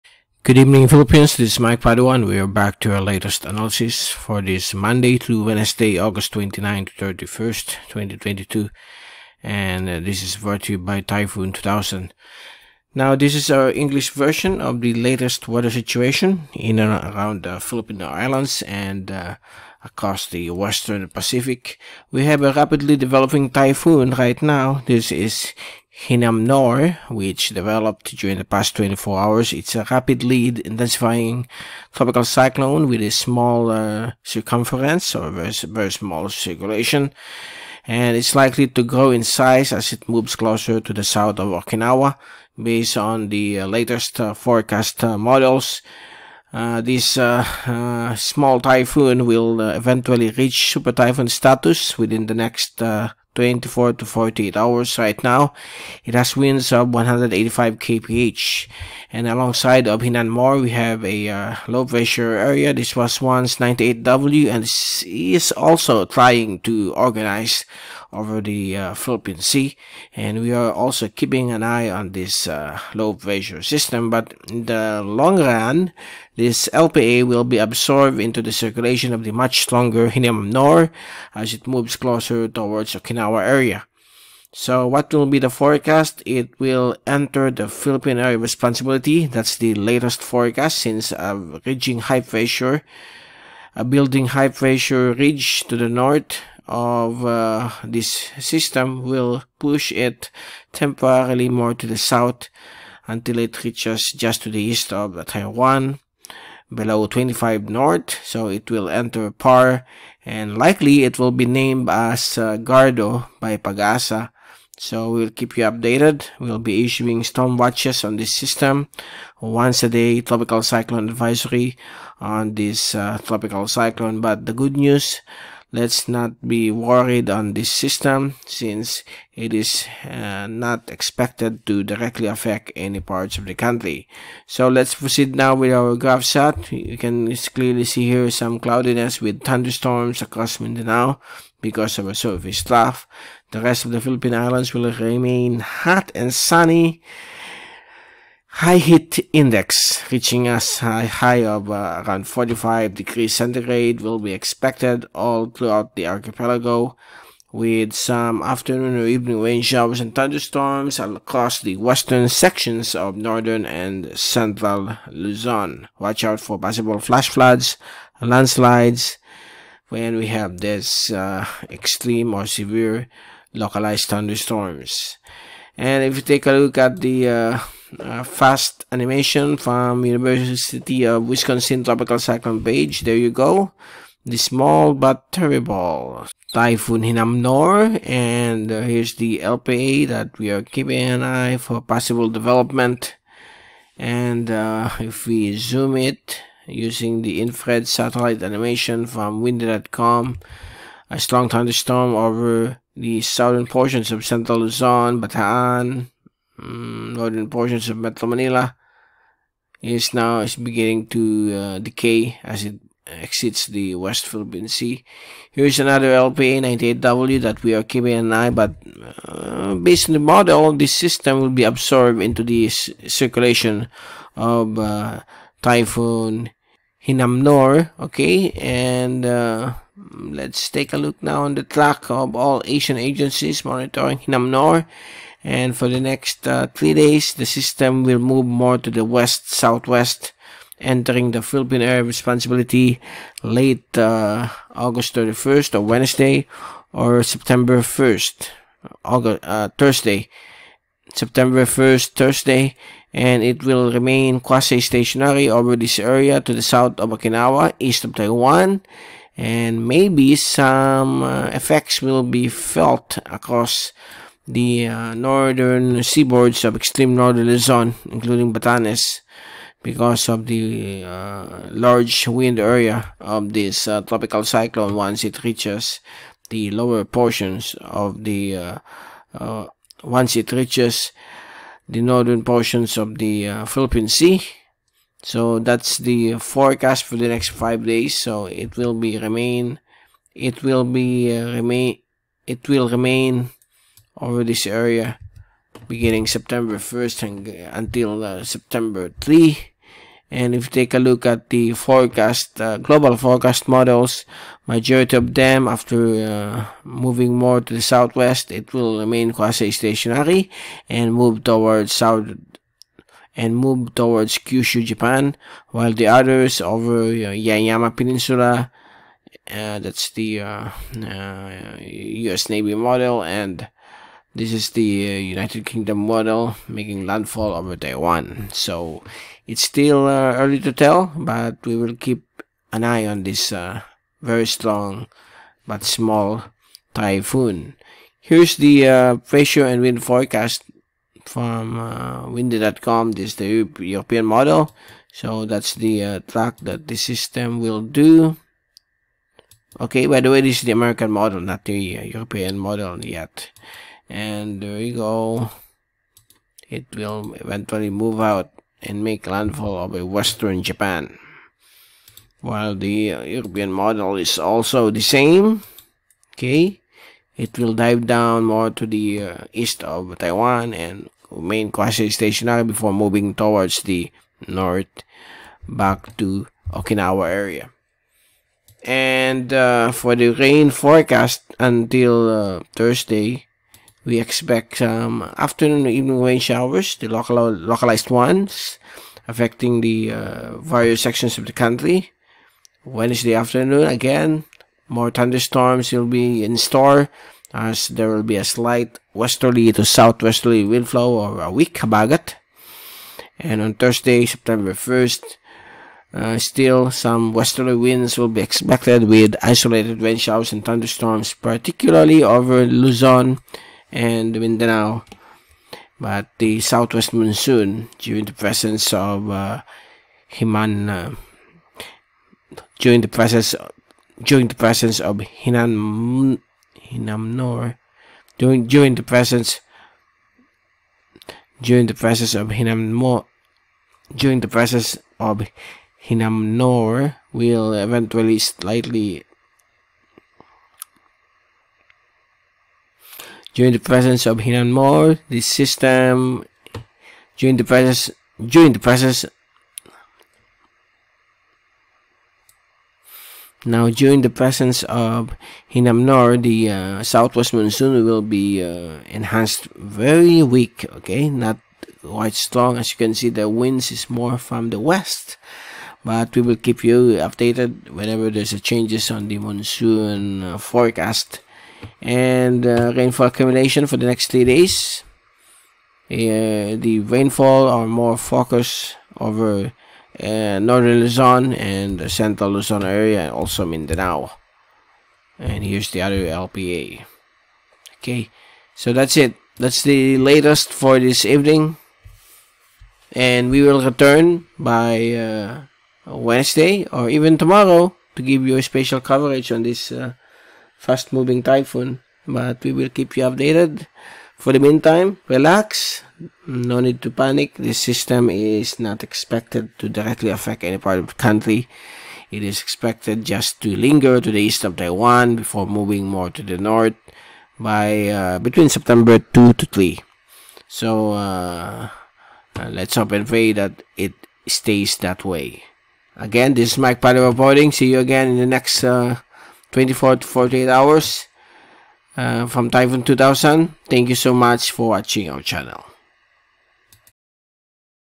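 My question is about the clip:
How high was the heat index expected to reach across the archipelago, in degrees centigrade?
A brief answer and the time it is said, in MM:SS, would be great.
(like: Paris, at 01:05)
45, at 02:32.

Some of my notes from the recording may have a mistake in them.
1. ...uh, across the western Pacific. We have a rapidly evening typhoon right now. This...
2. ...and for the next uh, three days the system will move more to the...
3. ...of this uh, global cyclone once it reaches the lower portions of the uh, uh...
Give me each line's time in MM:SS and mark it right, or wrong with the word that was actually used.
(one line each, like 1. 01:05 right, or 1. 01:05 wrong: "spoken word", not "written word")
1. 00:19 wrong: "developing", not "evening"
2. 03:55 right
3. 04:33 wrong: "tropical", not "global".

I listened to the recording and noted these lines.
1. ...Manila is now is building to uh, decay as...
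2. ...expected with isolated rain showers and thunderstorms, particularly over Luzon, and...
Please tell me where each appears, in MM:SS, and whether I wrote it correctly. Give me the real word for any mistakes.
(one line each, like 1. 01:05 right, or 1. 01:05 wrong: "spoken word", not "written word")
1. 03:28 wrong: "beginning", not "building"
2. 06:48 right.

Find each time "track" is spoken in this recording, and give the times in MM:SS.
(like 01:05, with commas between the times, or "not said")
03:51, 05:46.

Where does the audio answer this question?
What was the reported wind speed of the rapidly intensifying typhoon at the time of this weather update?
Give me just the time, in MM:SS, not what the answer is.
00:56.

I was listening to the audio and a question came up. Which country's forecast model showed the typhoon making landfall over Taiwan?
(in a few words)
United Kingdom.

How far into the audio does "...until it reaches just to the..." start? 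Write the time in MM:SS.
01:43.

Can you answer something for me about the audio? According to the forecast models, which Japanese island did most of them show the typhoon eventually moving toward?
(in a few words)
Kyushu.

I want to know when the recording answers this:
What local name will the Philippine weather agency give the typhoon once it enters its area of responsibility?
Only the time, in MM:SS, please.
01:52.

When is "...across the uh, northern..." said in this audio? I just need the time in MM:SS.
04:23.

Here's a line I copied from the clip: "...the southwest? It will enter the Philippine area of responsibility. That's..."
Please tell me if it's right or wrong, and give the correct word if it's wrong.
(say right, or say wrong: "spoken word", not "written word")
wrong: "forecast", not "southwest".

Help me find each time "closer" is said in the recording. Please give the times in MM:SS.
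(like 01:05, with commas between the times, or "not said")
00:40, 01:21.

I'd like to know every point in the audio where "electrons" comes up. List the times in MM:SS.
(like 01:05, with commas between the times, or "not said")
not said.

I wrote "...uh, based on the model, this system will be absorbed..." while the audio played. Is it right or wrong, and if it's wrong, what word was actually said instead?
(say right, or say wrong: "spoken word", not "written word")
right.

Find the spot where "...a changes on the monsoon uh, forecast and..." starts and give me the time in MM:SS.
07:48.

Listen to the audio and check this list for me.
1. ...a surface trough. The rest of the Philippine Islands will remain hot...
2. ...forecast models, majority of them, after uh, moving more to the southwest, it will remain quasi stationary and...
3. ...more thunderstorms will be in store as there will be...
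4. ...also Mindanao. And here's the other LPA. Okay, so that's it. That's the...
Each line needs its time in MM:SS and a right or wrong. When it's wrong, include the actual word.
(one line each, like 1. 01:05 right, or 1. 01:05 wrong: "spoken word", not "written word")
1. 02:22 right
2. 05:03 right
3. 06:34 right
4. 08:03 right.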